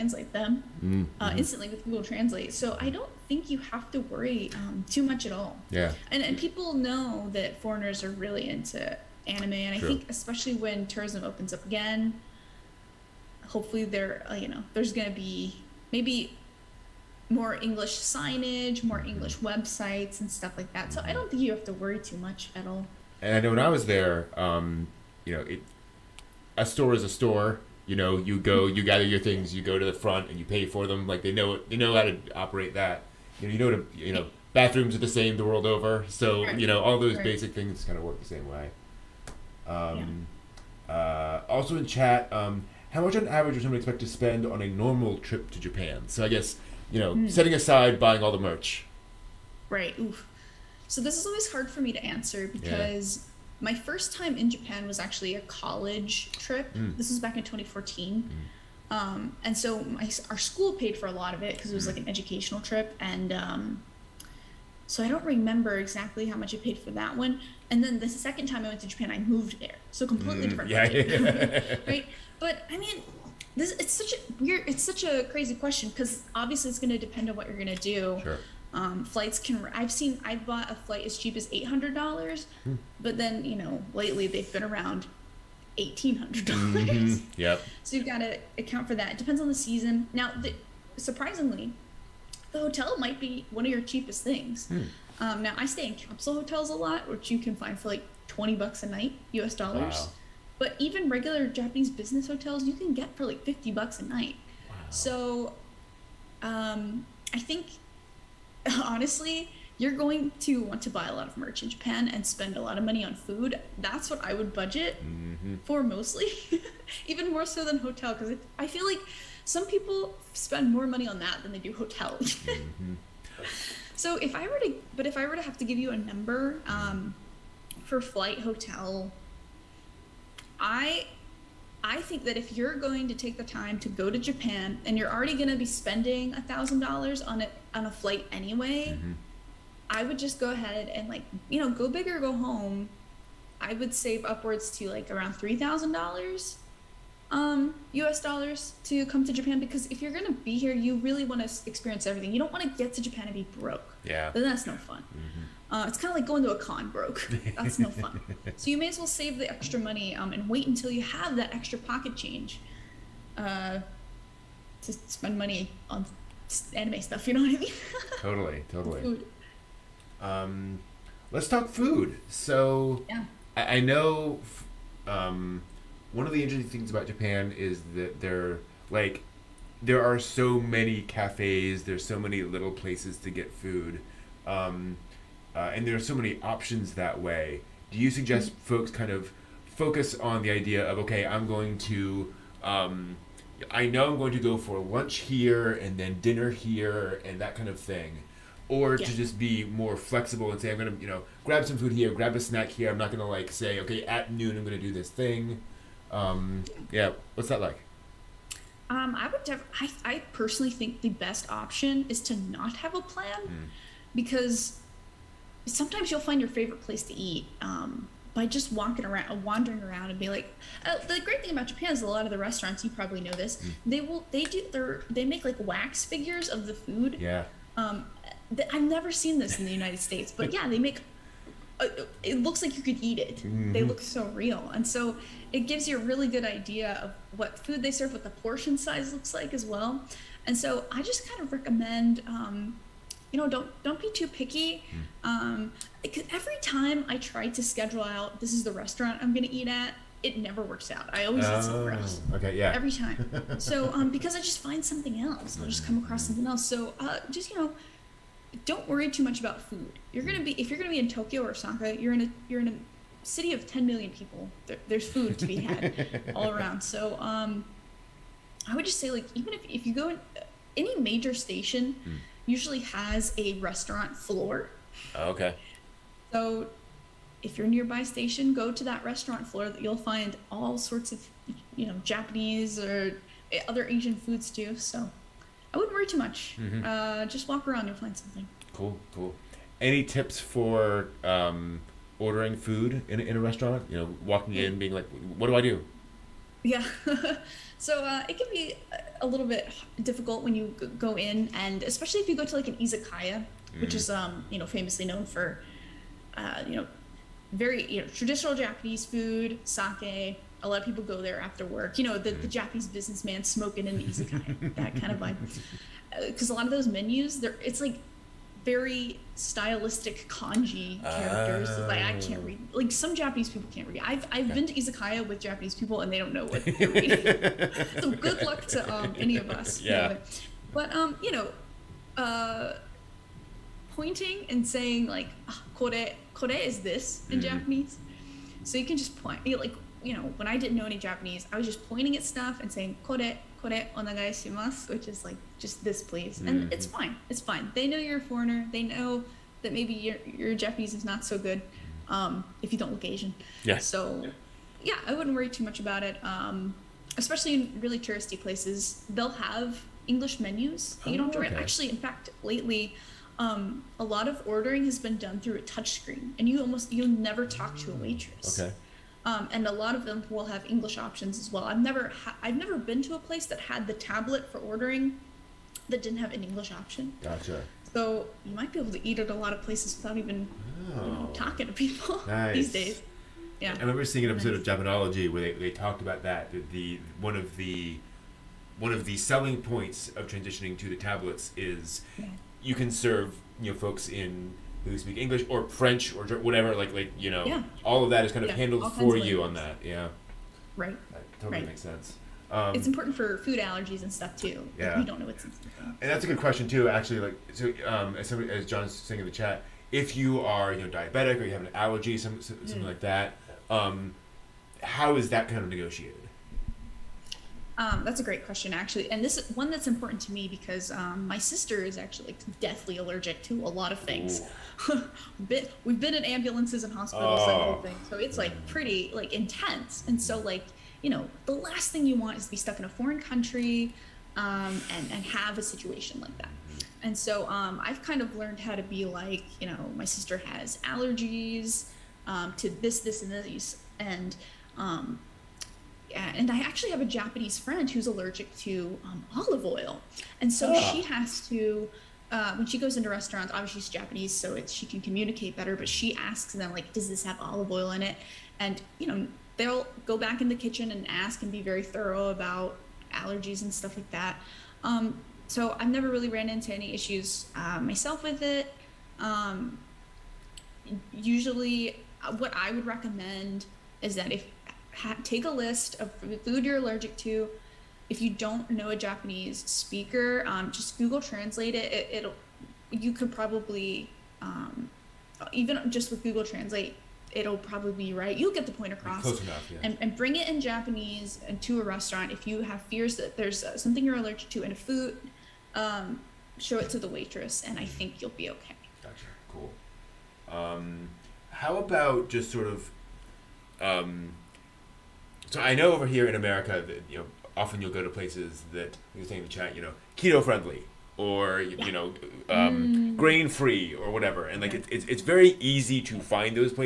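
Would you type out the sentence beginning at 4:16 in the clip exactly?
So uh, just you know, don't worry too much about food.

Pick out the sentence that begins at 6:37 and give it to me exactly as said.
all of that is kind of yeah, handled for you on that.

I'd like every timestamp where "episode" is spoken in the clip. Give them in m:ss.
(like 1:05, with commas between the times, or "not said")
6:24.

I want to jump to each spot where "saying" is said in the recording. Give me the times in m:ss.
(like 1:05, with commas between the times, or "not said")
5:34, 5:42, 6:48, 8:29.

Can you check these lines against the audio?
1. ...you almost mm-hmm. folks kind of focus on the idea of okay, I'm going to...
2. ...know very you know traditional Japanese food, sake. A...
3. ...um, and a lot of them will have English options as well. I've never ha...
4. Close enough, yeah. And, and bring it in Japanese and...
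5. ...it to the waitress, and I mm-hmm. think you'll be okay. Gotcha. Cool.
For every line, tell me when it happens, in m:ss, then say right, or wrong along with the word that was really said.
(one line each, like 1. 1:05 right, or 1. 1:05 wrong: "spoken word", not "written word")
1. 3:07 wrong: "suggest", not "almost"
2. 5:06 right
3. 6:09 right
4. 8:09 right
5. 8:16 right.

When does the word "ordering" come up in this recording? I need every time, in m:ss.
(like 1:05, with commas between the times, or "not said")
4:52, 6:04, 6:14.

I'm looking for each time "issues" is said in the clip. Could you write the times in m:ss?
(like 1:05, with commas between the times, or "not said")
7:46.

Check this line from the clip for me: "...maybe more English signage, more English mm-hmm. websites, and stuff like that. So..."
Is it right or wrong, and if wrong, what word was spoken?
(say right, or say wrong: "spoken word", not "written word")
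right.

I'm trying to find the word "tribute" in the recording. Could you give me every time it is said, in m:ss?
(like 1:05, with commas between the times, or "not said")
not said.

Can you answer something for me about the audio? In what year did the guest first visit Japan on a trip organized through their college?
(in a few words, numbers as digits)
2014.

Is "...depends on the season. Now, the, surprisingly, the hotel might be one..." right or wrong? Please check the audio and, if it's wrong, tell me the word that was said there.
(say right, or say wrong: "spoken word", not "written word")
right.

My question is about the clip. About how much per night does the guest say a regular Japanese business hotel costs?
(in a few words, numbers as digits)
$50.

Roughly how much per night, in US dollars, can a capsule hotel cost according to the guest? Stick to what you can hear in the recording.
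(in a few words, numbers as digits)
$20.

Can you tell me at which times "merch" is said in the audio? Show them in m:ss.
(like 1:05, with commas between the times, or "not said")
0:48, 1:51.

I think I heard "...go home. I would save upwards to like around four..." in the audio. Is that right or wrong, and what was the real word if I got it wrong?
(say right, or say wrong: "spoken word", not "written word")
wrong: "three", not "four".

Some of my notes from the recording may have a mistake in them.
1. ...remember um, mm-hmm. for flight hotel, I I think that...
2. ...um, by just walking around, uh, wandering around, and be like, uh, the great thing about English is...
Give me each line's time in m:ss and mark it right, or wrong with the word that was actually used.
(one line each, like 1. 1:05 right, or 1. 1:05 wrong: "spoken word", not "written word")
1. 2:05 wrong: "number", not "remember"
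2. 3:37 wrong: "Japan", not "English".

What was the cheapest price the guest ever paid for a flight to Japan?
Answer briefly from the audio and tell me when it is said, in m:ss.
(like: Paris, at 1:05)
$800, at 1:21.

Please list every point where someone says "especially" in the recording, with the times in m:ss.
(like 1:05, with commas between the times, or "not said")
0:10, 5:01, 5:57.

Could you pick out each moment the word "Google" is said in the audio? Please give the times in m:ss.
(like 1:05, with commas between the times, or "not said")
0:01, 8:00, 8:06.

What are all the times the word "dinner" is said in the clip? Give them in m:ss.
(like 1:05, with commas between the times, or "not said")
3:16.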